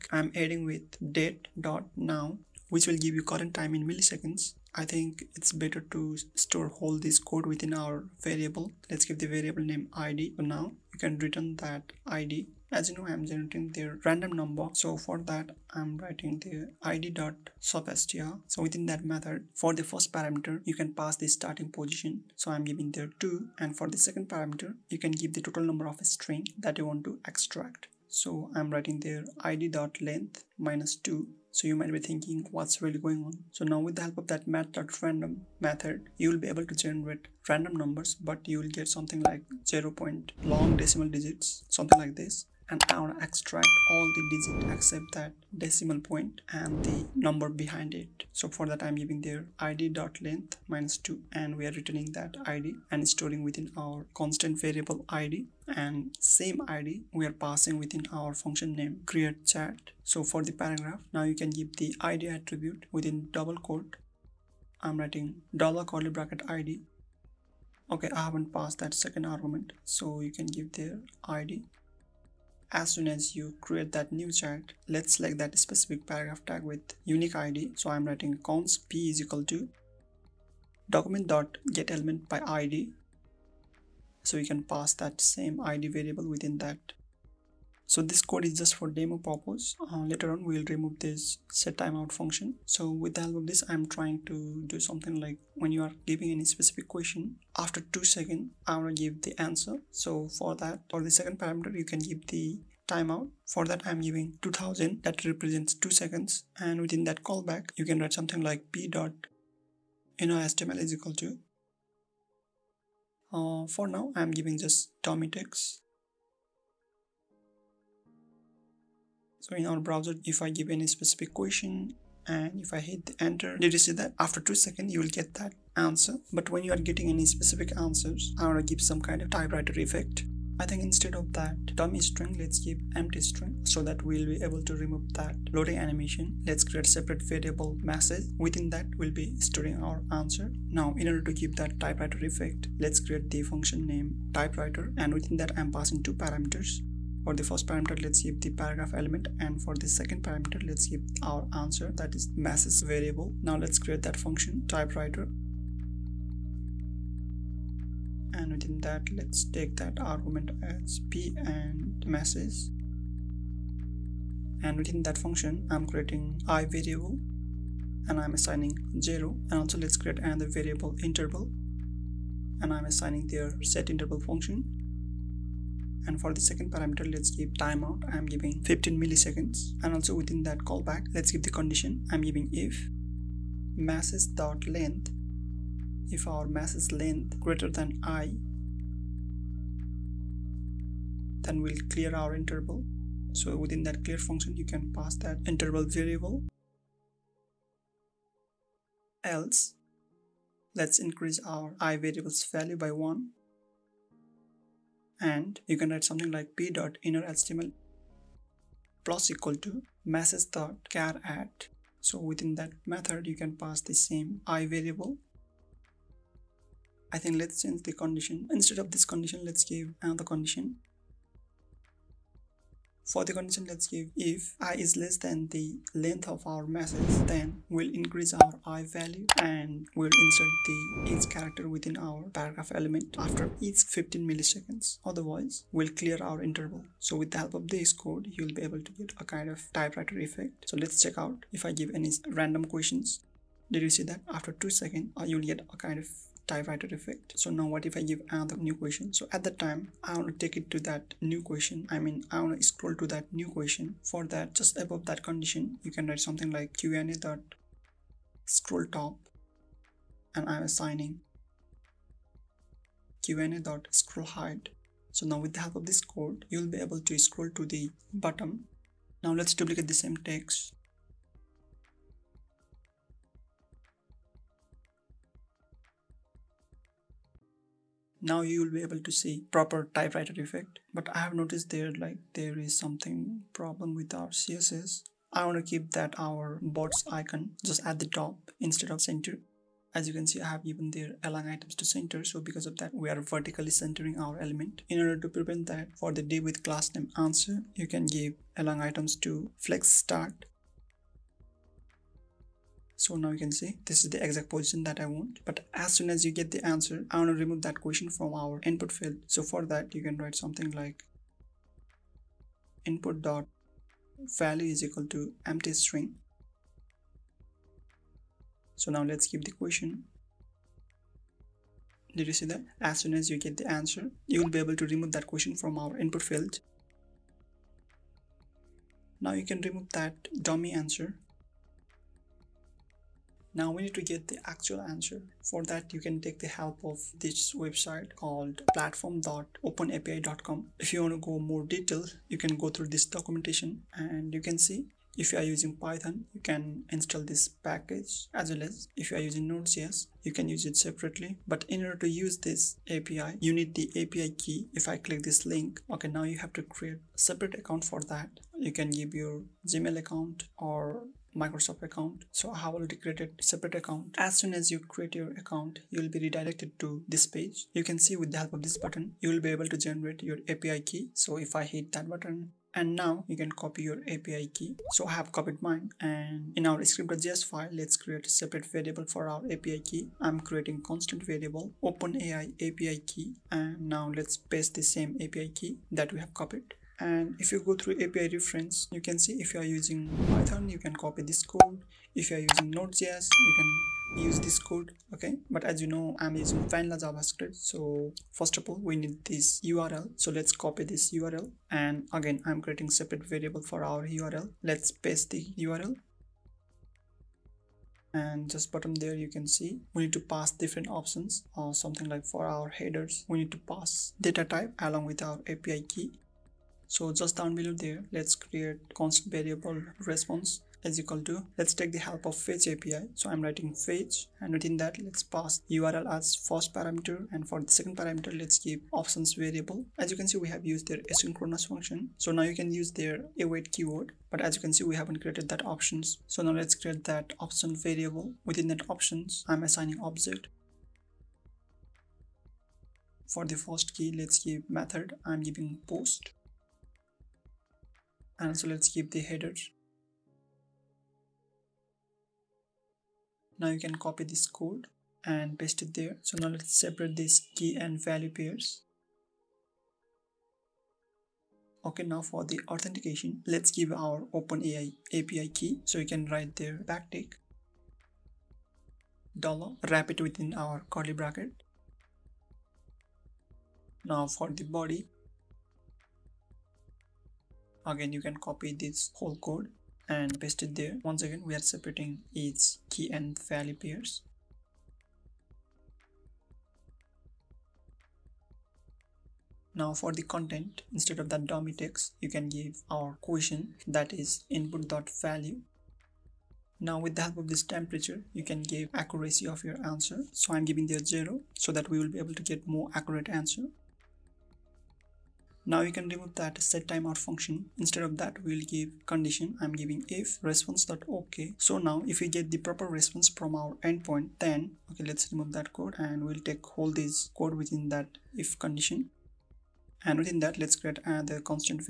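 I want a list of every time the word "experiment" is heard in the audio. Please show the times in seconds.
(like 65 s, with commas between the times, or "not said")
not said.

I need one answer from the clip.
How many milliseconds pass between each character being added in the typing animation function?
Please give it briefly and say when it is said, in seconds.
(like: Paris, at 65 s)
15 milliseconds, at 178 s.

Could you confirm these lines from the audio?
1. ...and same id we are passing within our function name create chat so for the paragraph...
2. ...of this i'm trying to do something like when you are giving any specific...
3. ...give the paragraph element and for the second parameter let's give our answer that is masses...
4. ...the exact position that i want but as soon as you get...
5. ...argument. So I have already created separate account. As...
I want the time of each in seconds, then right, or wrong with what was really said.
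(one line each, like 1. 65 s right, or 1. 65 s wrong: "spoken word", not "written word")
1. 55 s right
2. 93 s right
3. 148 s right
4. 304 s right
5. 361 s wrong: "account", not "argument".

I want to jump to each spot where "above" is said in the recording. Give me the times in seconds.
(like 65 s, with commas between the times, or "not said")
254 s.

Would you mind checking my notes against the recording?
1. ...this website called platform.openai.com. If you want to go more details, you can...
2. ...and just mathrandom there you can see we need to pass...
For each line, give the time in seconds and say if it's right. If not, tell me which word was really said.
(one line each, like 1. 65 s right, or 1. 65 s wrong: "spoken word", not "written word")
1. 337 s right
2. 408 s wrong: "bottom", not "mathrandom".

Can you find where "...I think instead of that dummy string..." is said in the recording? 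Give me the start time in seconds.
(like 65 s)
130 s.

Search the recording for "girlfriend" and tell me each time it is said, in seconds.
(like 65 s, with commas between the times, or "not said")
not said.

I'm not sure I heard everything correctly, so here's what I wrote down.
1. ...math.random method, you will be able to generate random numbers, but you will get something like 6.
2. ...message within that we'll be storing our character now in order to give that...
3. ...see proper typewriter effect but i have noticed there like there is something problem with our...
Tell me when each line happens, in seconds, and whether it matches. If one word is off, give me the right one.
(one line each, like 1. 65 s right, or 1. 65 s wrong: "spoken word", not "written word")
1. 34 s wrong: "0", not "6"
2. 137 s wrong: "answer", not "character"
3. 279 s right.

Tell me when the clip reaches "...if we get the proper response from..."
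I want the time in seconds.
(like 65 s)
512 s.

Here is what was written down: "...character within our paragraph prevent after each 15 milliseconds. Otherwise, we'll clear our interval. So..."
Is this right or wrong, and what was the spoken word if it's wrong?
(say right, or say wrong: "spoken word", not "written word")
wrong: "element", not "prevent".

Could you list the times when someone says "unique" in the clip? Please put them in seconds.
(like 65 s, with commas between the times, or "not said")
77 s.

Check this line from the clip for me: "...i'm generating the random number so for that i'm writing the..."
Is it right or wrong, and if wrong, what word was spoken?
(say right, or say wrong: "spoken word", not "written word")
right.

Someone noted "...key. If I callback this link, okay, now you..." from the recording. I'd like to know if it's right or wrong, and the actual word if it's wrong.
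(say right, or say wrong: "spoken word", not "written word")
wrong: "click", not "callback".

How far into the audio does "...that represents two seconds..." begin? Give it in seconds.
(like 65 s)
105 s.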